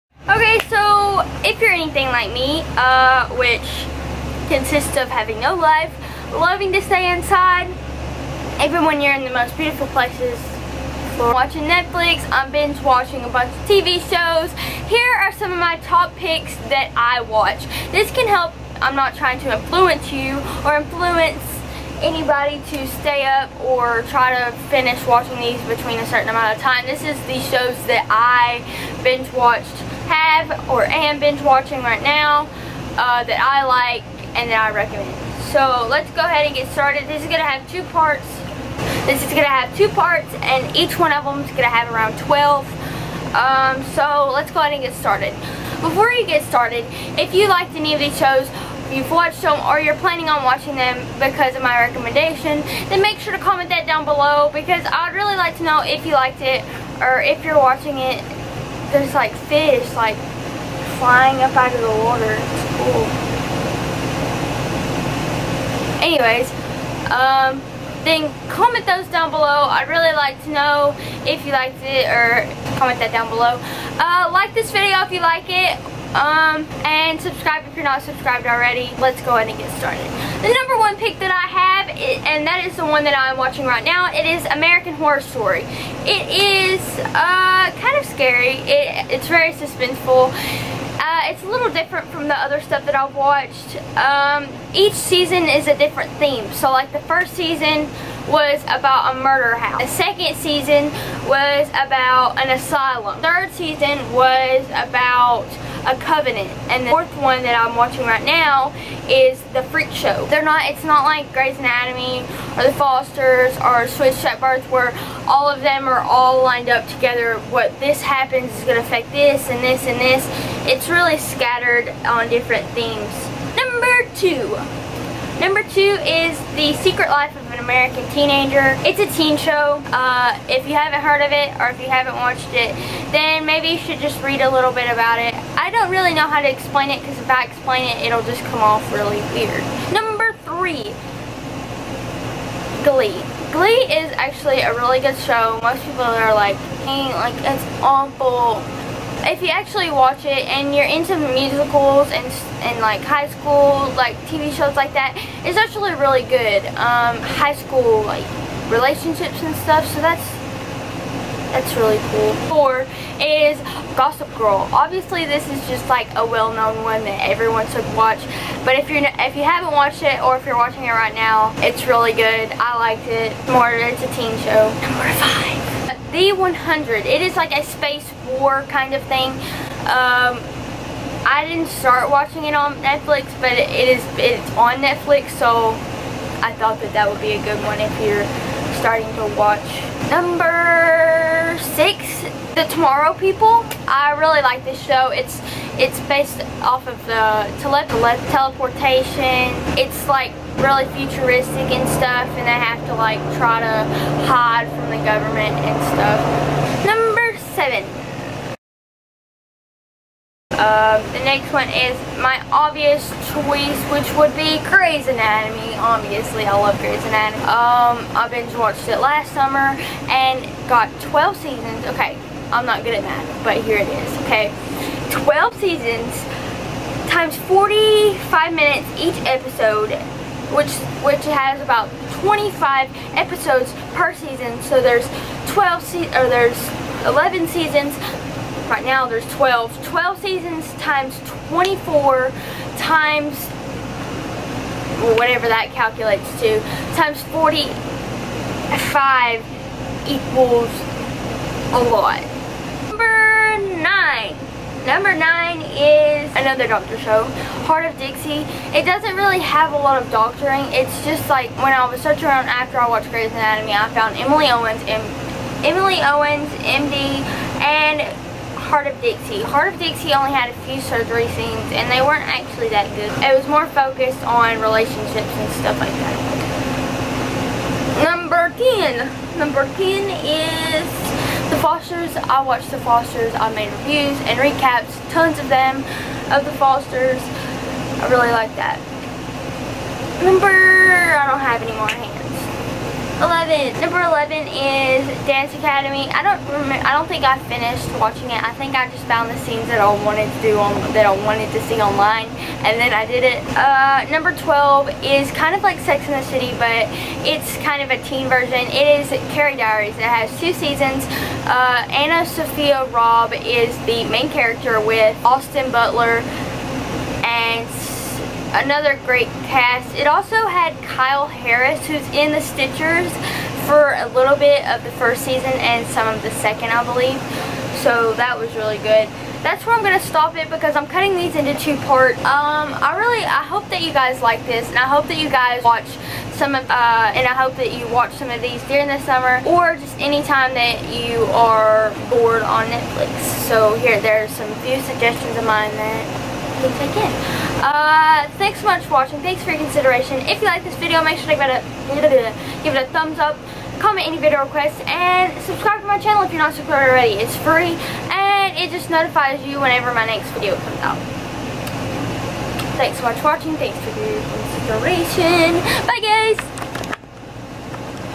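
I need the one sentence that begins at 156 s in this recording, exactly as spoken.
Um, high school like relationships and stuff.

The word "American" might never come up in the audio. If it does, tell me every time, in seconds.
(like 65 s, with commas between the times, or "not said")
84 s, 127 s.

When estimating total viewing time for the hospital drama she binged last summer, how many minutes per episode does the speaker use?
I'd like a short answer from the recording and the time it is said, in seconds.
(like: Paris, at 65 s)
45, at 227 s.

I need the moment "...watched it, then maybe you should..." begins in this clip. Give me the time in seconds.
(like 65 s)
132 s.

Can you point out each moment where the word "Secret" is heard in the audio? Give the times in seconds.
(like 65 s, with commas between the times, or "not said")
126 s.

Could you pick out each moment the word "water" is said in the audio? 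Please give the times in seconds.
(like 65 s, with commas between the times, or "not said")
61 s.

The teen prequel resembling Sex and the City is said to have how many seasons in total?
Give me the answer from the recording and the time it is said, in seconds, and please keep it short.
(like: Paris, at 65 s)
2, at 310 s.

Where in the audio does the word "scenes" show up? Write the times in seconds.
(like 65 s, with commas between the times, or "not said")
271 s, 299 s.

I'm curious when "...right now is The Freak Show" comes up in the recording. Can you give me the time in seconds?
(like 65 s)
108 s.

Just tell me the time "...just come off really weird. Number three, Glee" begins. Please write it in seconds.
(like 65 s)
138 s.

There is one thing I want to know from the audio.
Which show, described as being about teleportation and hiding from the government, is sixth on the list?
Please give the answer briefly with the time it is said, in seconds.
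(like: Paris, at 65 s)
The Tomorrow People, at 192 s.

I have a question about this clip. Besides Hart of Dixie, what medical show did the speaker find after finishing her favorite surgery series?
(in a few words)
Emily Owens, MD.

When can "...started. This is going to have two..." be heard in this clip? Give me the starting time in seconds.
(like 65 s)
36 s.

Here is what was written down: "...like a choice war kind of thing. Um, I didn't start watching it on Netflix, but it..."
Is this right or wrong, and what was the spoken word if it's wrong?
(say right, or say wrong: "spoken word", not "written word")
wrong: "space", not "choice".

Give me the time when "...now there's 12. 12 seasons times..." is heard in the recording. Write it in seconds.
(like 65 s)
238 s.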